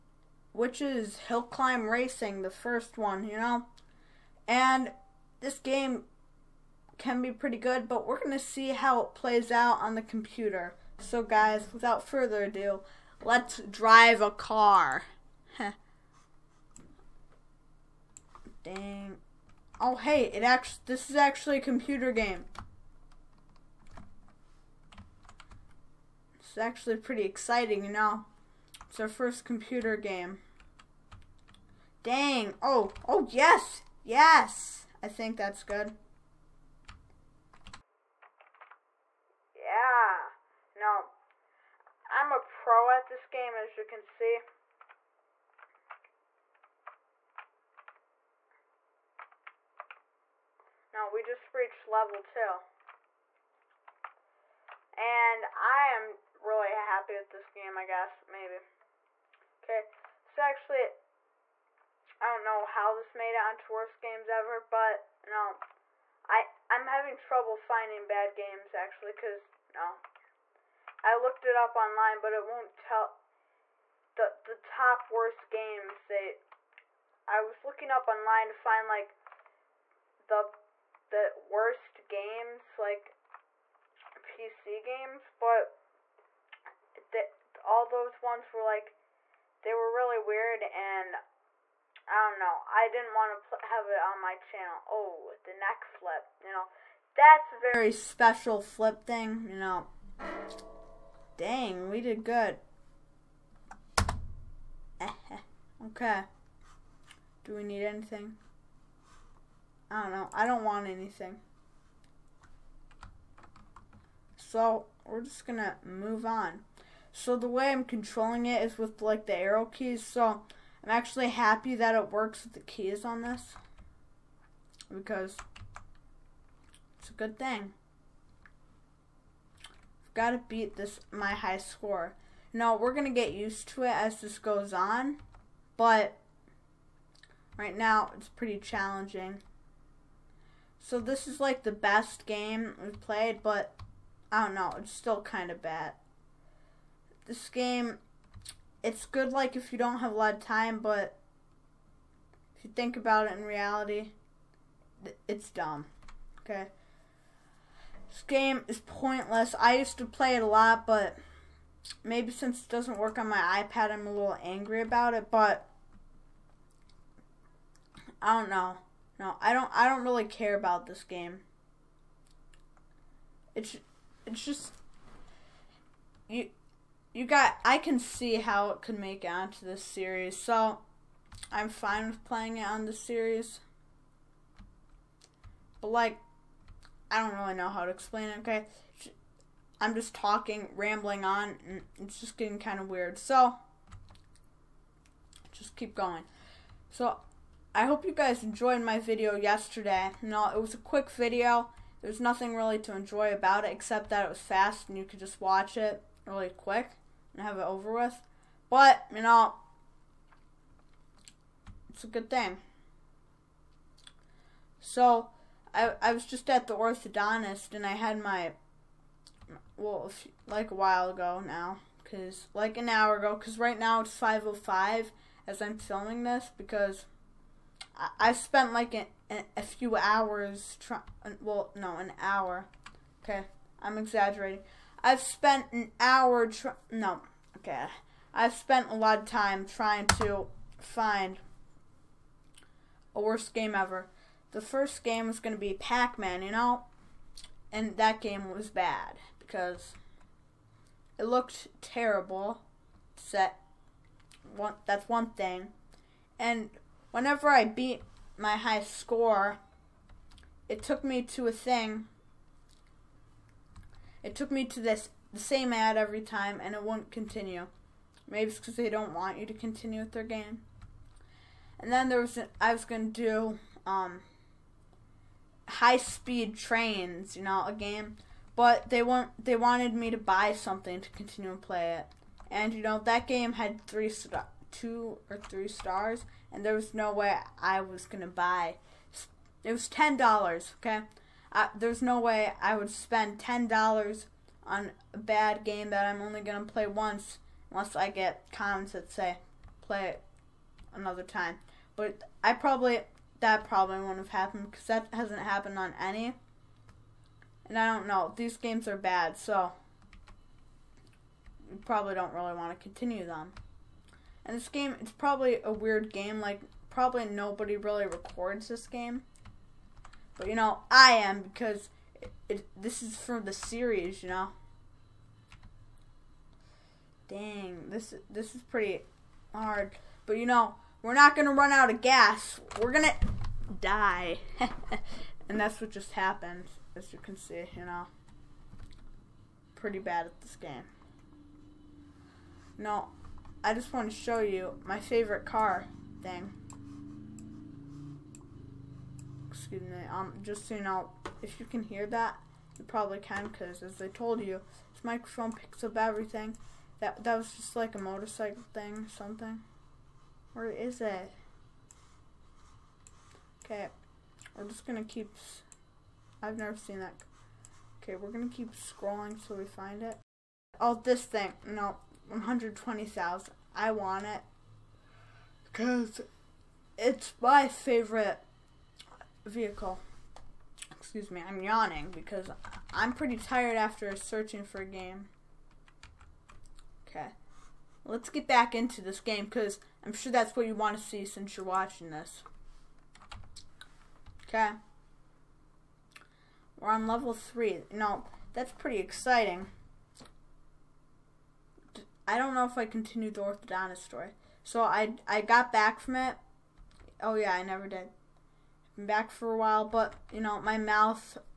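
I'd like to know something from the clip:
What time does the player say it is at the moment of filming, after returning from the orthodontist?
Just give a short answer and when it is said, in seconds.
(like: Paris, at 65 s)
5:05, at 224 s.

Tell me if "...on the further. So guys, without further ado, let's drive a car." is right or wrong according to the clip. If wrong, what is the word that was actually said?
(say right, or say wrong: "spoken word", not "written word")
wrong: "computer", not "further".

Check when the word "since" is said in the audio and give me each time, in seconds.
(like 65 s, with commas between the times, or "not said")
162 s, 391 s.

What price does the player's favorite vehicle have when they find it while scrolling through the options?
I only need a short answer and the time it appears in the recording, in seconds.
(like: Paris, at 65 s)
120,000, at 372 s.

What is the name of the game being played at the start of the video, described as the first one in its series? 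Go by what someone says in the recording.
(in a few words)
Hill Climb Racing.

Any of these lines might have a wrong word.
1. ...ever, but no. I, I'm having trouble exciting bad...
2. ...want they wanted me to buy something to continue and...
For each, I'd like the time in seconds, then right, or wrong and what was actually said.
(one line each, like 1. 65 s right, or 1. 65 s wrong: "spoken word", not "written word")
1. 64 s wrong: "finding", not "exciting"
2. 279 s right.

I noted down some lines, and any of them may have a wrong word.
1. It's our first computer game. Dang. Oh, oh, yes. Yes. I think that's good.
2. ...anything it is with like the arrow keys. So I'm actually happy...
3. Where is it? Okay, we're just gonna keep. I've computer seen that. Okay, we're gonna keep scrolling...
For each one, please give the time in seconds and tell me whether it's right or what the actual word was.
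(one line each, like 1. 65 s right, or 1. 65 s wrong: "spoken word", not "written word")
1. 28 s right
2. 117 s wrong: "controlling", not "anything"
3. 360 s wrong: "never", not "computer".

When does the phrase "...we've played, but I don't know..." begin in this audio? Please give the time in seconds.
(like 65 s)
142 s.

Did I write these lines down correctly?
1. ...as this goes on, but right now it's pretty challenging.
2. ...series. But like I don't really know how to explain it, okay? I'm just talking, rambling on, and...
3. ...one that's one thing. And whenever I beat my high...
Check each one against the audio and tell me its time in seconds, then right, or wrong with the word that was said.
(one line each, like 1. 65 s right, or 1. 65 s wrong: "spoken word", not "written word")
1. 133 s right
2. 182 s right
3. 254 s right.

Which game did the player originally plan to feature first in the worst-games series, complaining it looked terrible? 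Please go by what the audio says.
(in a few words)
Pac-Man.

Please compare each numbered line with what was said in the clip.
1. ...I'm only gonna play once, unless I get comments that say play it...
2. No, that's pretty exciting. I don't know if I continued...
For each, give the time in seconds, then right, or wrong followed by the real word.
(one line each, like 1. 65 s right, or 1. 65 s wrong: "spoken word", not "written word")
1. 296 s right
2. 397 s right.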